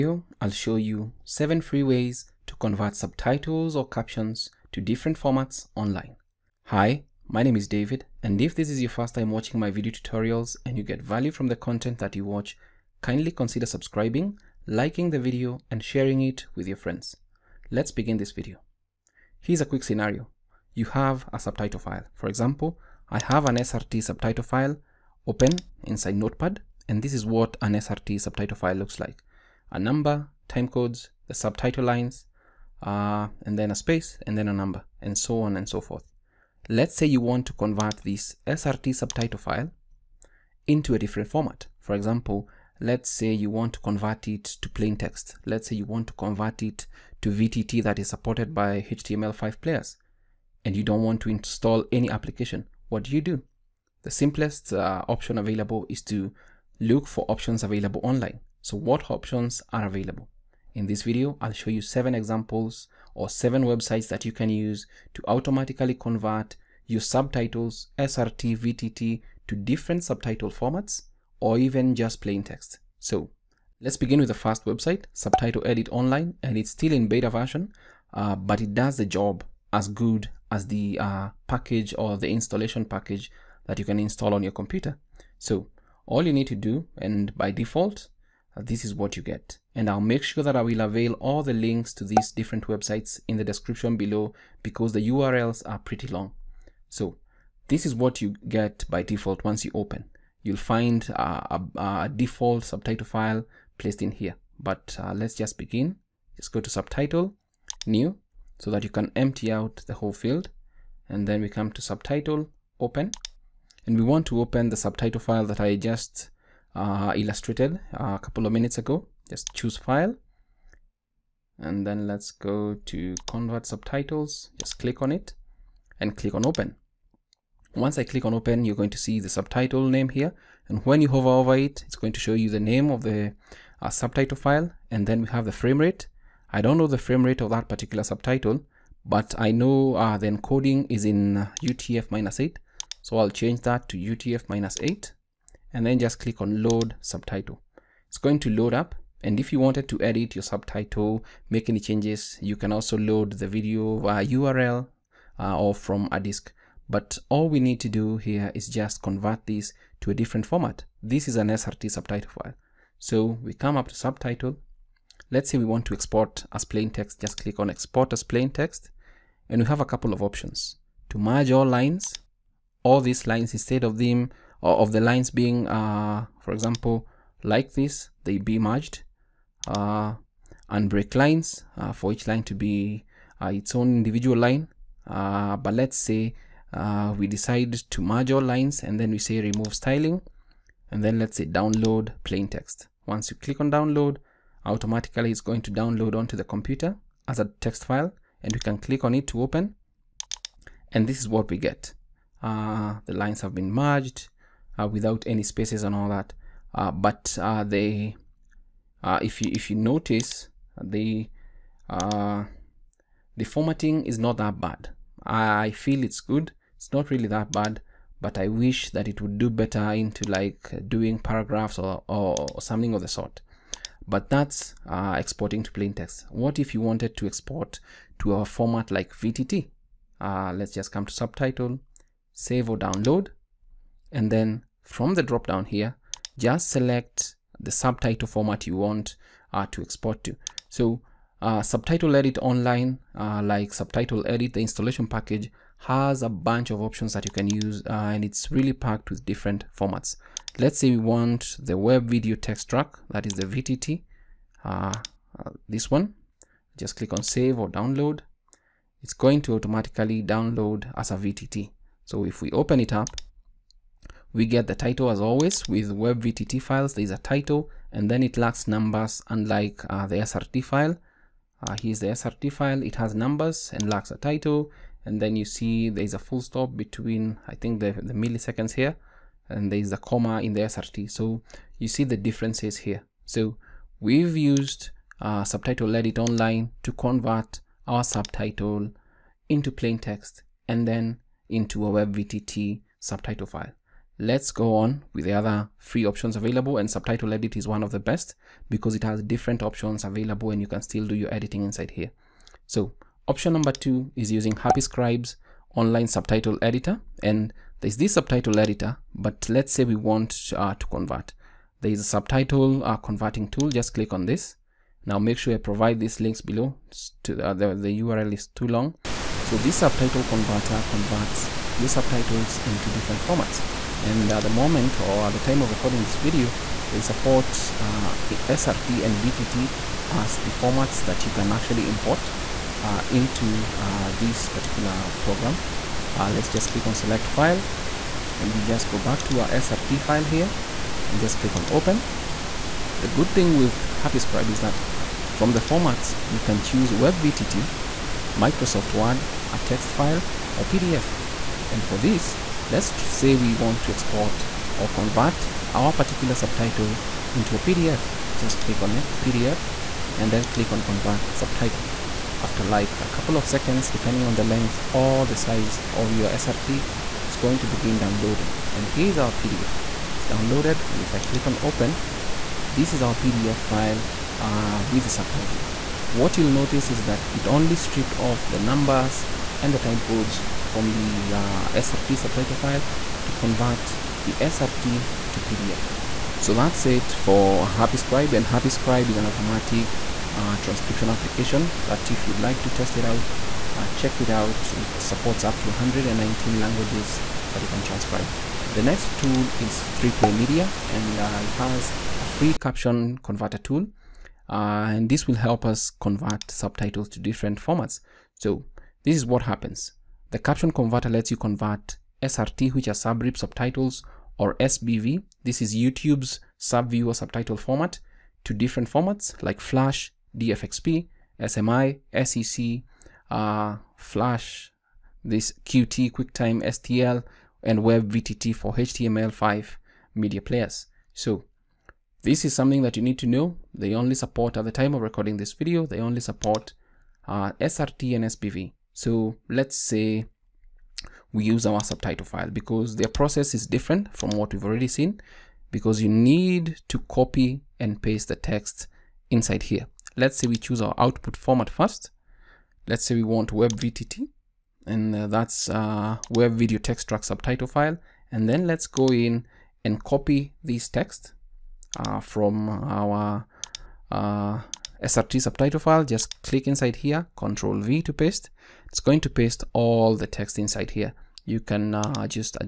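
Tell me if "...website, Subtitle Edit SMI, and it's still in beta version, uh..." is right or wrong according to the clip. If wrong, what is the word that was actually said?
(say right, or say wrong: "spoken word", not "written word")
wrong: "Online", not "SMI".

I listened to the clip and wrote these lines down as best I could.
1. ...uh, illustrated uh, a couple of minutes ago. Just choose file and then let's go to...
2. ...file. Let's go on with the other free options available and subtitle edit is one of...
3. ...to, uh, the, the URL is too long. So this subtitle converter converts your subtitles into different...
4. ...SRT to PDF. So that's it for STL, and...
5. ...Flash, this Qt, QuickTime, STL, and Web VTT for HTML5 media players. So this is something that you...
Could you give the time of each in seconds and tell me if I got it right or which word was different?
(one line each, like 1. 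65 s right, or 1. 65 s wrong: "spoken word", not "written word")
1. 116 s right
2. 293 s right
3. 317 s right
4. 384 s wrong: "Scribe", not "STL"
5. 423 s right.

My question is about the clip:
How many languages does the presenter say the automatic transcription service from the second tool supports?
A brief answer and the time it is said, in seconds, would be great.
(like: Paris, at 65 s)
119, at 395 s.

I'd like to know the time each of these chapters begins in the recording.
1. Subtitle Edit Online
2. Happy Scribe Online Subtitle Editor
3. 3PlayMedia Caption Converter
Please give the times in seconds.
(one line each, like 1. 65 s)
1. 77 s
2. 303 s
3. 399 s.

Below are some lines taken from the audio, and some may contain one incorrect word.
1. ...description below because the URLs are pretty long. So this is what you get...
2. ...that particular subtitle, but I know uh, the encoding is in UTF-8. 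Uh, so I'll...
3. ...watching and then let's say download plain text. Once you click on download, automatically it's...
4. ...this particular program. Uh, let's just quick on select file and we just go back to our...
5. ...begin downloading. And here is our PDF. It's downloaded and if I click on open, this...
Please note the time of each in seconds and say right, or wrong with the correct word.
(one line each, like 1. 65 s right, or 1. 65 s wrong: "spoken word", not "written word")
1. 93 s right
2. 137 s right
3. 189 s wrong: "styling", not "watching"
4. 334 s wrong: "click", not "quick"
5. 367 s right.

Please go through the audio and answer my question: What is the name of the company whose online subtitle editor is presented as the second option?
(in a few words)
Happy Scribe.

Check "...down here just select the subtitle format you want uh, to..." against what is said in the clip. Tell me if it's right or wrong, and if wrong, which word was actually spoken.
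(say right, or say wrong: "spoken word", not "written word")
right.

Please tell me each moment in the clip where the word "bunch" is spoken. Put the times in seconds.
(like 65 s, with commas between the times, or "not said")
246 s.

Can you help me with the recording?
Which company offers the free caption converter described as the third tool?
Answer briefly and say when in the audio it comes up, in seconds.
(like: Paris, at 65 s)
3Play Media, at 399 s.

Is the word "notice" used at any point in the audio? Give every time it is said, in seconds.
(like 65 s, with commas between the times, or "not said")
209 s, 376 s.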